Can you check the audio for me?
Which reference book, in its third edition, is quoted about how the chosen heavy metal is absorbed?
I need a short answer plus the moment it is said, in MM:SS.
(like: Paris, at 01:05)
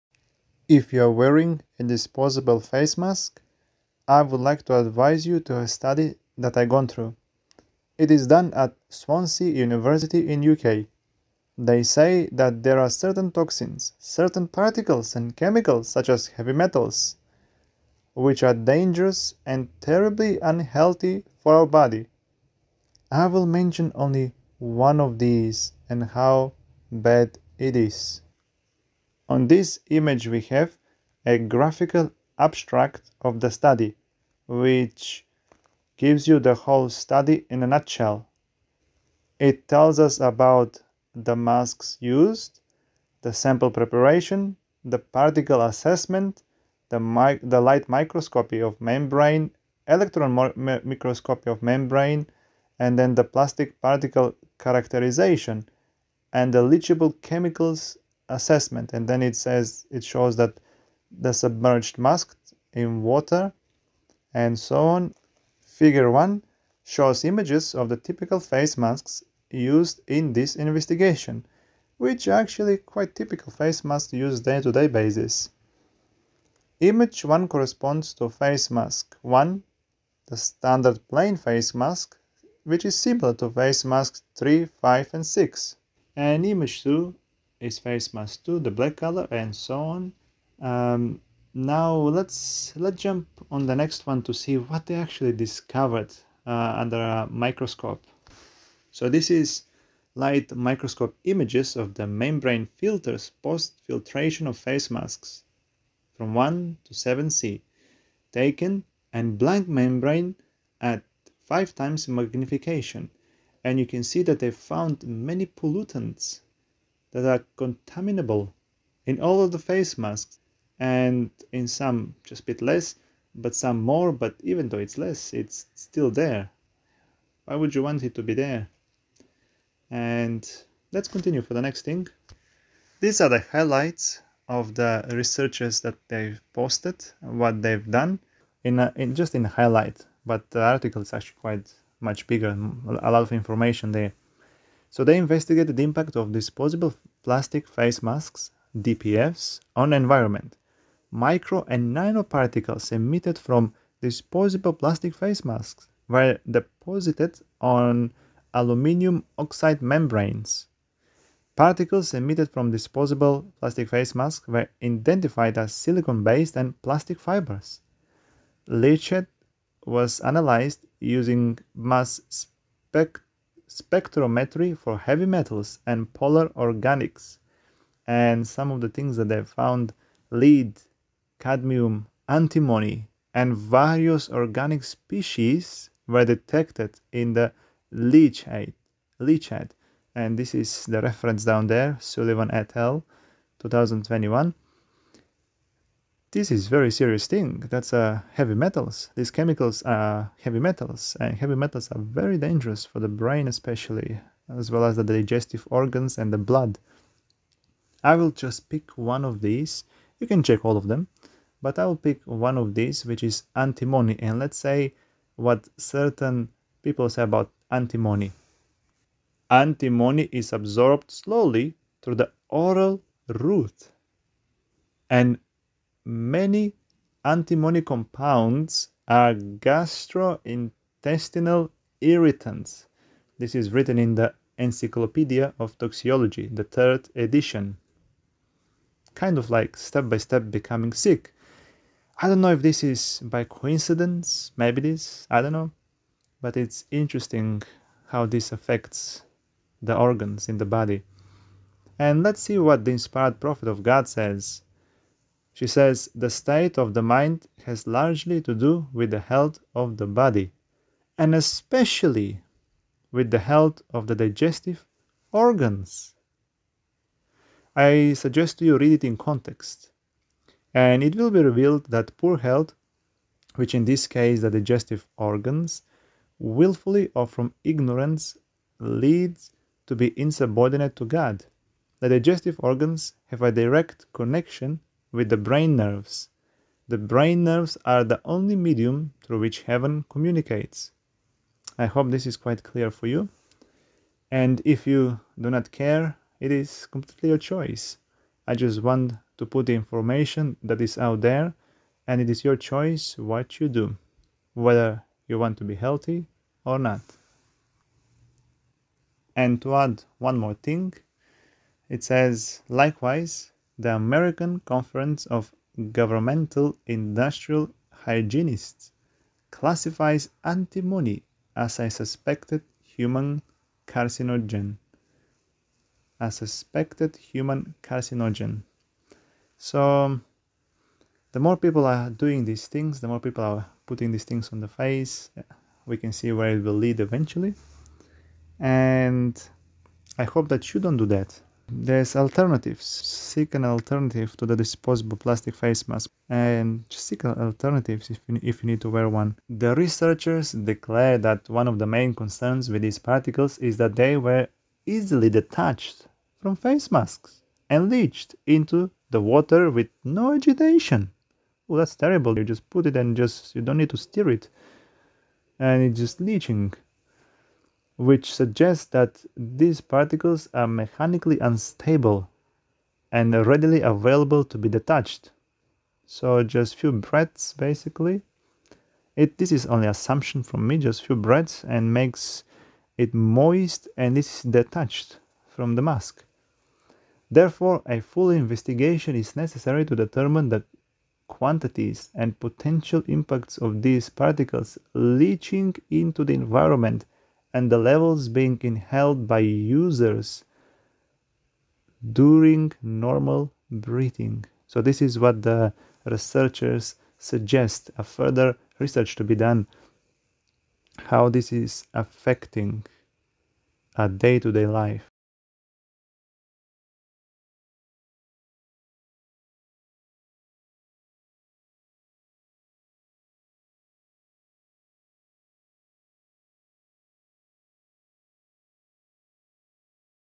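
Encyclopedia of Toxicology, at 03:54.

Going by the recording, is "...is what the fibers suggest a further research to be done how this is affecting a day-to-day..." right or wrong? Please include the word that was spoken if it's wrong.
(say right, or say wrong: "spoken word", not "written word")
wrong: "researchers", not "fibers".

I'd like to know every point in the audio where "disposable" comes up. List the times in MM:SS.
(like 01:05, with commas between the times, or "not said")
00:01, 02:26, 02:34, 02:42, 05:44.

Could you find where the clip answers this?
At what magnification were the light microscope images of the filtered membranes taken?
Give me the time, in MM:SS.
01:51.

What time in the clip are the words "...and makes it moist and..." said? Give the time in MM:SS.
06:21.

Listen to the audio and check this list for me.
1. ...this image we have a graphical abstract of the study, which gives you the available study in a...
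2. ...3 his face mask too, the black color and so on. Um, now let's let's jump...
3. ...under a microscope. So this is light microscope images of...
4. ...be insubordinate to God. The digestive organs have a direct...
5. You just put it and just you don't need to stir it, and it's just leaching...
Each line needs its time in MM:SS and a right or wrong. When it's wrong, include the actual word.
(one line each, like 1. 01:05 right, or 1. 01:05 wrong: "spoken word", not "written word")
1. 00:29 wrong: "whole", not "available"
2. 01:26 wrong: "2", not "3"
3. 01:36 right
4. 04:39 right
5. 06:02 right.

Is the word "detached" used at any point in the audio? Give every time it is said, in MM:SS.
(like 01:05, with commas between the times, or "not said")
05:55, 06:14, 06:24.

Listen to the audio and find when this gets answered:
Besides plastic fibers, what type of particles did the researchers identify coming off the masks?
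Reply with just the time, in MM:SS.
02:45.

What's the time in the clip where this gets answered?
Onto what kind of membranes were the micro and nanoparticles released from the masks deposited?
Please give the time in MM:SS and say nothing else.
02:38.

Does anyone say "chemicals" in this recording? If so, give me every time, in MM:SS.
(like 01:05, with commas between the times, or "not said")
00:15, 00:57, 03:19.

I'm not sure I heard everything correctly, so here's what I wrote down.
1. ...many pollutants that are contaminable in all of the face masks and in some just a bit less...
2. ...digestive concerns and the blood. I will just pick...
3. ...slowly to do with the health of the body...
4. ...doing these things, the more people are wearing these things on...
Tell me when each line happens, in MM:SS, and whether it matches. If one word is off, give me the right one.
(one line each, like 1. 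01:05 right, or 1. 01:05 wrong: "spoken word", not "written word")
1. 01:55 right
2. 03:25 wrong: "organs", not "concerns"
3. 04:17 wrong: "largely", not "slowly"
4. 05:32 wrong: "putting", not "wearing".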